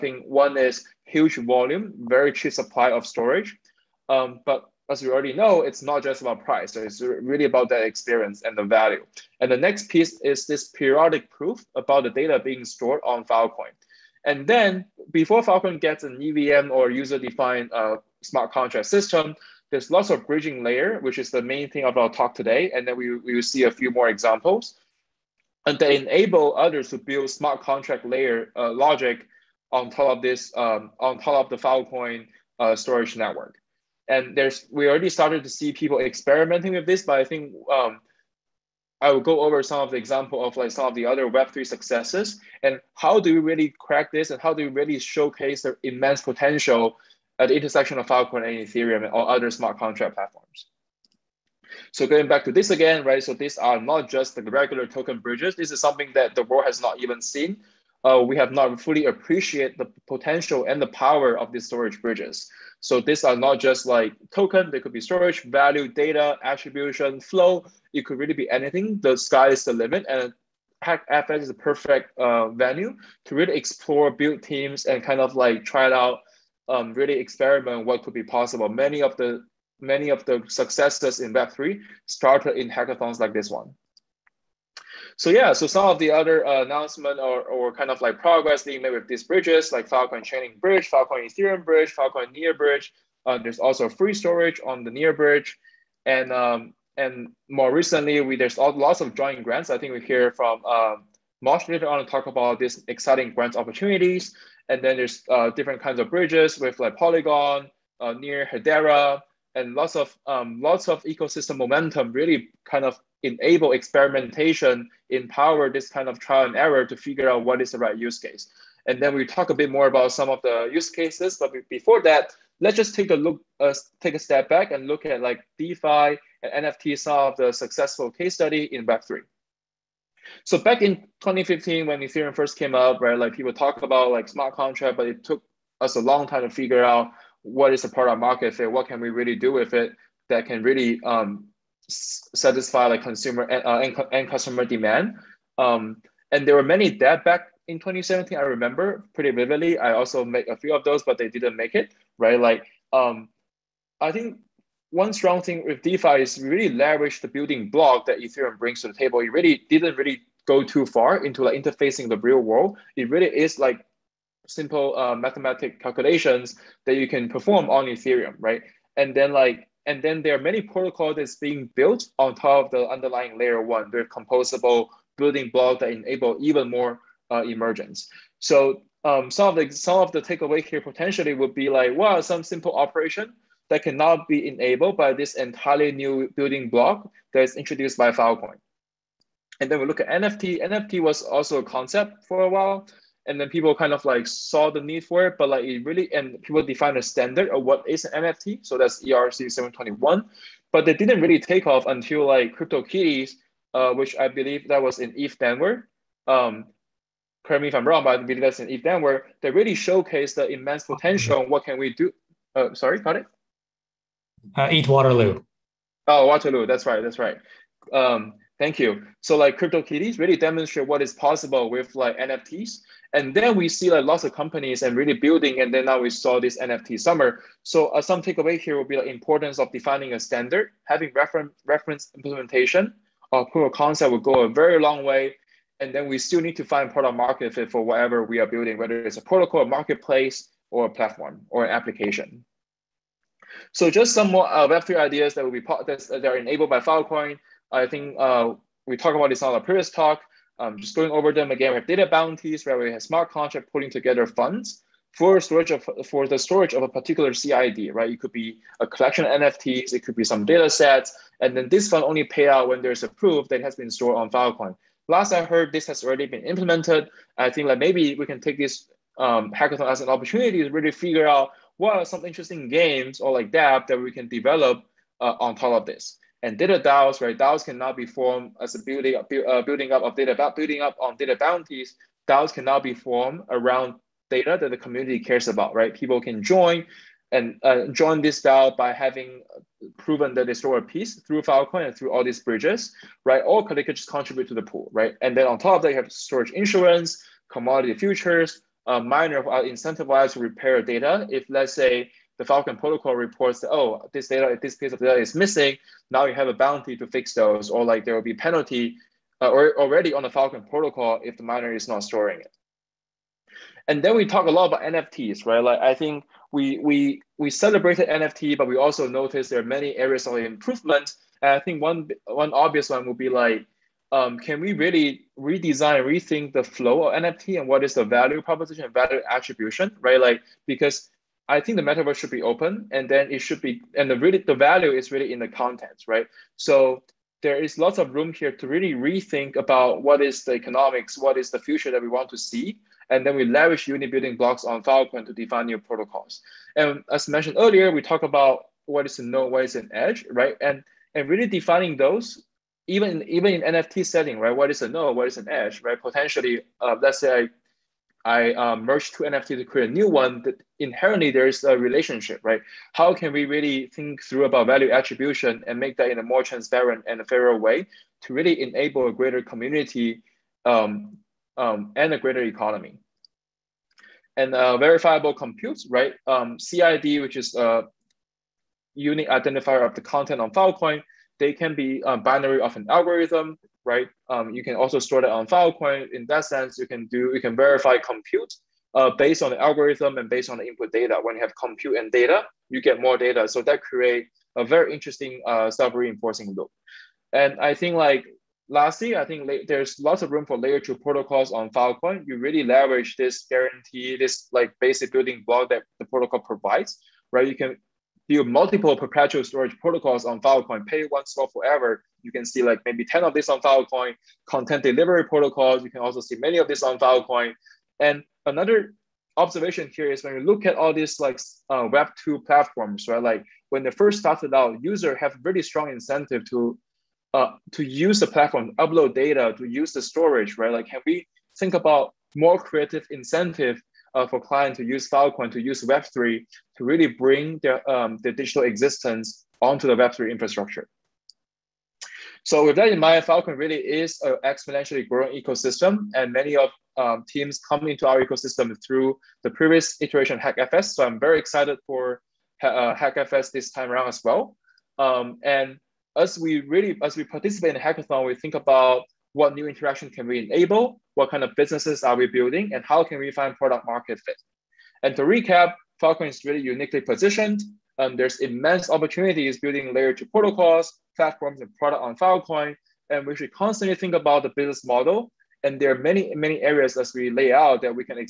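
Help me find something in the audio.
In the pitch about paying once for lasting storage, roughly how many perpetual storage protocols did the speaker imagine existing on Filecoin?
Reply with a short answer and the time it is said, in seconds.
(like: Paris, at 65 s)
10, at 413 s.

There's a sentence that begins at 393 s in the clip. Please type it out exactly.
So that create a very interesting uh, self-reinforcing loop.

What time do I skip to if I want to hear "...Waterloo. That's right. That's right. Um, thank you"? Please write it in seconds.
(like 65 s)
216 s.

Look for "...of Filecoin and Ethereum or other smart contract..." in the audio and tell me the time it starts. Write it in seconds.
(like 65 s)
47 s.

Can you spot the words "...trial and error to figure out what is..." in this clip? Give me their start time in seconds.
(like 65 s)
116 s.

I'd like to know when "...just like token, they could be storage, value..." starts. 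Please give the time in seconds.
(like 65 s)
63 s.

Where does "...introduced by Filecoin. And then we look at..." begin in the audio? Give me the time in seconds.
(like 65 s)
187 s.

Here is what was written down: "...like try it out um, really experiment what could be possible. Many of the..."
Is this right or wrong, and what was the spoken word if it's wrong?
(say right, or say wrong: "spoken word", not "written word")
right.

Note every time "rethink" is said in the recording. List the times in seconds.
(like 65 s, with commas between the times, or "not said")
326 s, 338 s.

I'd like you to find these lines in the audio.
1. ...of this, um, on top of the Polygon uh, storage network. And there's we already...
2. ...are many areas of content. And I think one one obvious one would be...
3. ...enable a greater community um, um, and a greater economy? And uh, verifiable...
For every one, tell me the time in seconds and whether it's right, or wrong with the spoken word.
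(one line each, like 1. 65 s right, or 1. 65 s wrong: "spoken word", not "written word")
1. 30 s wrong: "Filecoin", not "Polygon"
2. 319 s wrong: "improvement", not "content"
3. 368 s right.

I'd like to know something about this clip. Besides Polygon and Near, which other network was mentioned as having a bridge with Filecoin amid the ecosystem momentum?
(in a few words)
Hedera.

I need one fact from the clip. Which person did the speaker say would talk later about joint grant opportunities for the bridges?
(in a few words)
Mosh.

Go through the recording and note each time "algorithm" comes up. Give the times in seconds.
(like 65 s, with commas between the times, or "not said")
382 s, 389 s.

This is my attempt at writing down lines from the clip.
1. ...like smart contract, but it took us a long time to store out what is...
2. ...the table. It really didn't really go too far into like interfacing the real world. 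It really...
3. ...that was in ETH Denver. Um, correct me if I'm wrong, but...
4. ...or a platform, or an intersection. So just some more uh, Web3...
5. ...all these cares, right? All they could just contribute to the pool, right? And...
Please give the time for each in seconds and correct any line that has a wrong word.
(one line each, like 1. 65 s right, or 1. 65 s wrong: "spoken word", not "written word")
1. 134 s wrong: "figure", not "store"
2. 158 s right
3. 204 s right
4. 240 s wrong: "application", not "intersection"
5. 292 s wrong: "bridges", not "cares".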